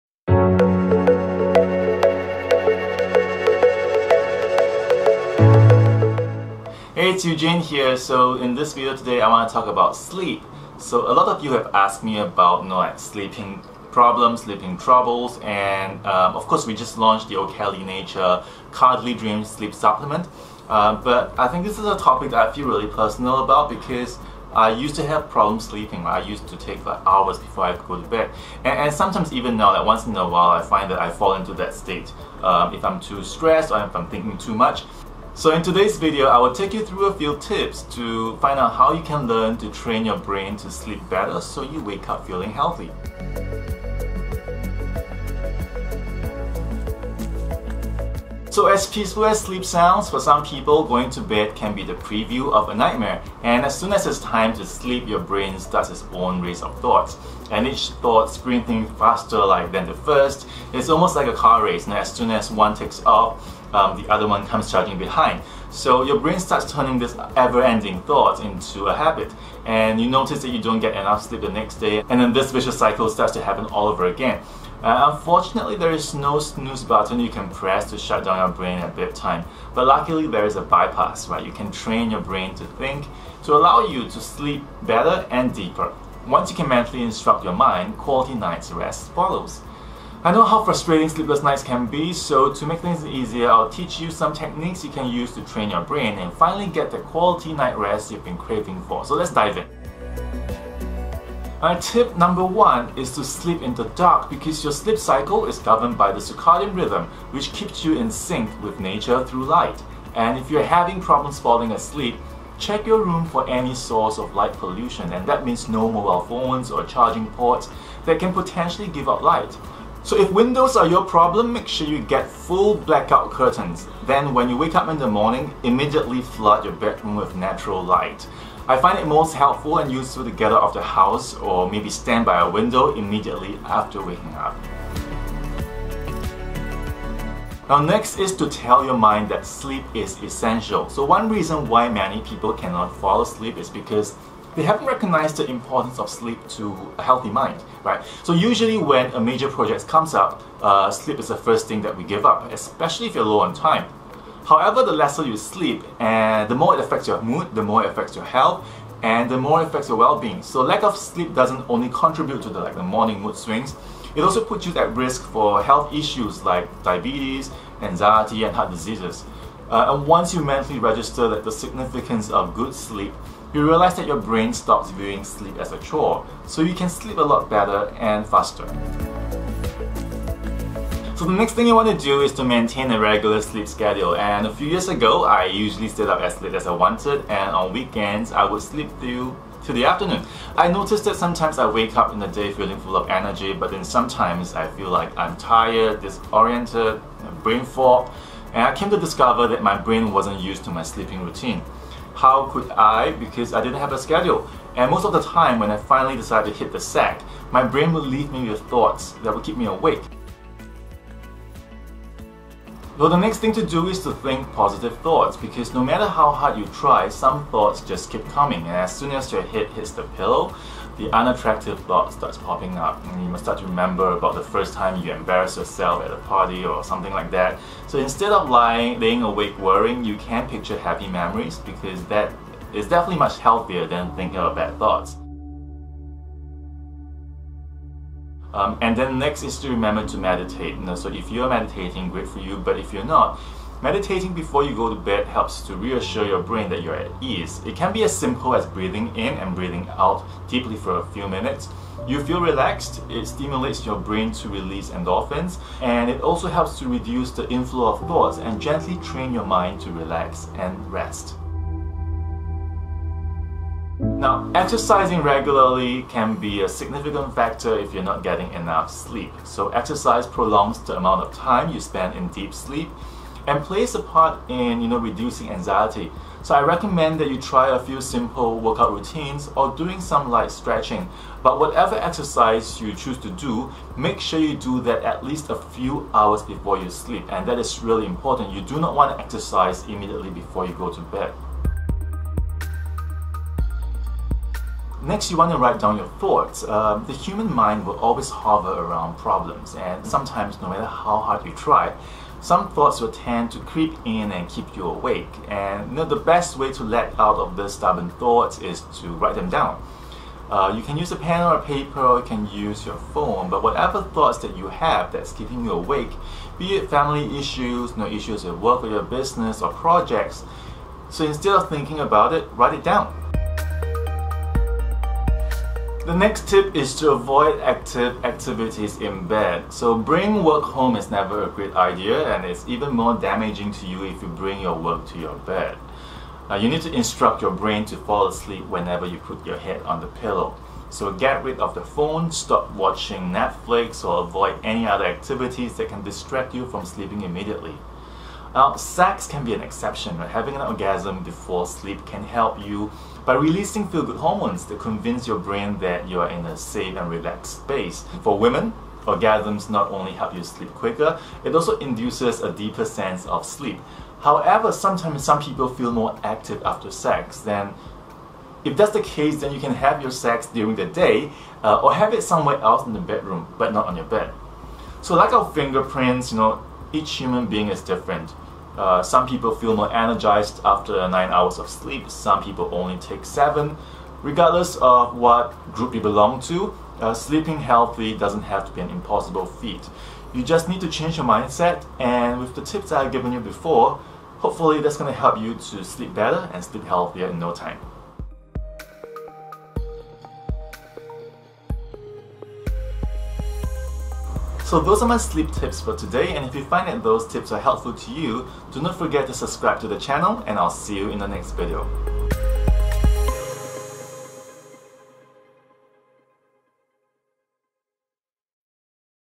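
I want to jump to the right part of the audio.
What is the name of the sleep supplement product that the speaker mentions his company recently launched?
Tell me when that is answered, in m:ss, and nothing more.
0:17.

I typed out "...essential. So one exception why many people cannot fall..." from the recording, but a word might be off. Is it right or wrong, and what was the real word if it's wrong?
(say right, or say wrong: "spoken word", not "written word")
wrong: "reason", not "exception".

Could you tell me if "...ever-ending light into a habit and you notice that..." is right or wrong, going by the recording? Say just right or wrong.
wrong.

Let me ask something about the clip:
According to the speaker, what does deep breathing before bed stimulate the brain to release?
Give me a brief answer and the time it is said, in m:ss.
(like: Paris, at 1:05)
endorphins, at 4:14.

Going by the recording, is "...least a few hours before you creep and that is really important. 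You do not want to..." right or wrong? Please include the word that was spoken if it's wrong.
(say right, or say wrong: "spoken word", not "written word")
wrong: "sleep", not "creep".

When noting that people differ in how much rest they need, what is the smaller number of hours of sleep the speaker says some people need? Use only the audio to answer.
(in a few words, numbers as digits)
7.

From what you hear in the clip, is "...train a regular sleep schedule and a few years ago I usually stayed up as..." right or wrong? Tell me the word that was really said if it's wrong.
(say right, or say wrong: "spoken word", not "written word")
wrong: "maintain", not "train".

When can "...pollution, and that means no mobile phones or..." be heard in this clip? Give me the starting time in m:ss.
1:54.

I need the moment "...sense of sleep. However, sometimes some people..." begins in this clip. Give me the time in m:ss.
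6:02.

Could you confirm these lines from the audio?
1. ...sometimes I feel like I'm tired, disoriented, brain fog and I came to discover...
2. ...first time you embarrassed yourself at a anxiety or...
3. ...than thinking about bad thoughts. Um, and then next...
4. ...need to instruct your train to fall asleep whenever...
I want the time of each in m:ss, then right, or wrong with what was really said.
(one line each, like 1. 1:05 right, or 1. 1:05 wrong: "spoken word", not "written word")
1. 3:13 right
2. 3:44 wrong: "party", not "anxiety"
3. 3:53 right
4. 5:36 wrong: "brain", not "train".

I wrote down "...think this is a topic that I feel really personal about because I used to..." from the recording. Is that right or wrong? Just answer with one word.
right.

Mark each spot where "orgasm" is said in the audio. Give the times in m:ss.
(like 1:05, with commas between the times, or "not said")
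5:50, 5:59.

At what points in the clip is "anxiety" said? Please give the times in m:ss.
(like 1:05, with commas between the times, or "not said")
2:47, 4:35.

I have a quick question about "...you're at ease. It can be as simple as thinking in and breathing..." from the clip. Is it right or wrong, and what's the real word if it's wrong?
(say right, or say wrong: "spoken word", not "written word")
wrong: "breathing", not "thinking".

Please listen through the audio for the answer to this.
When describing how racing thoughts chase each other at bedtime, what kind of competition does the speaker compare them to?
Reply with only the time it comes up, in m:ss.
1:01.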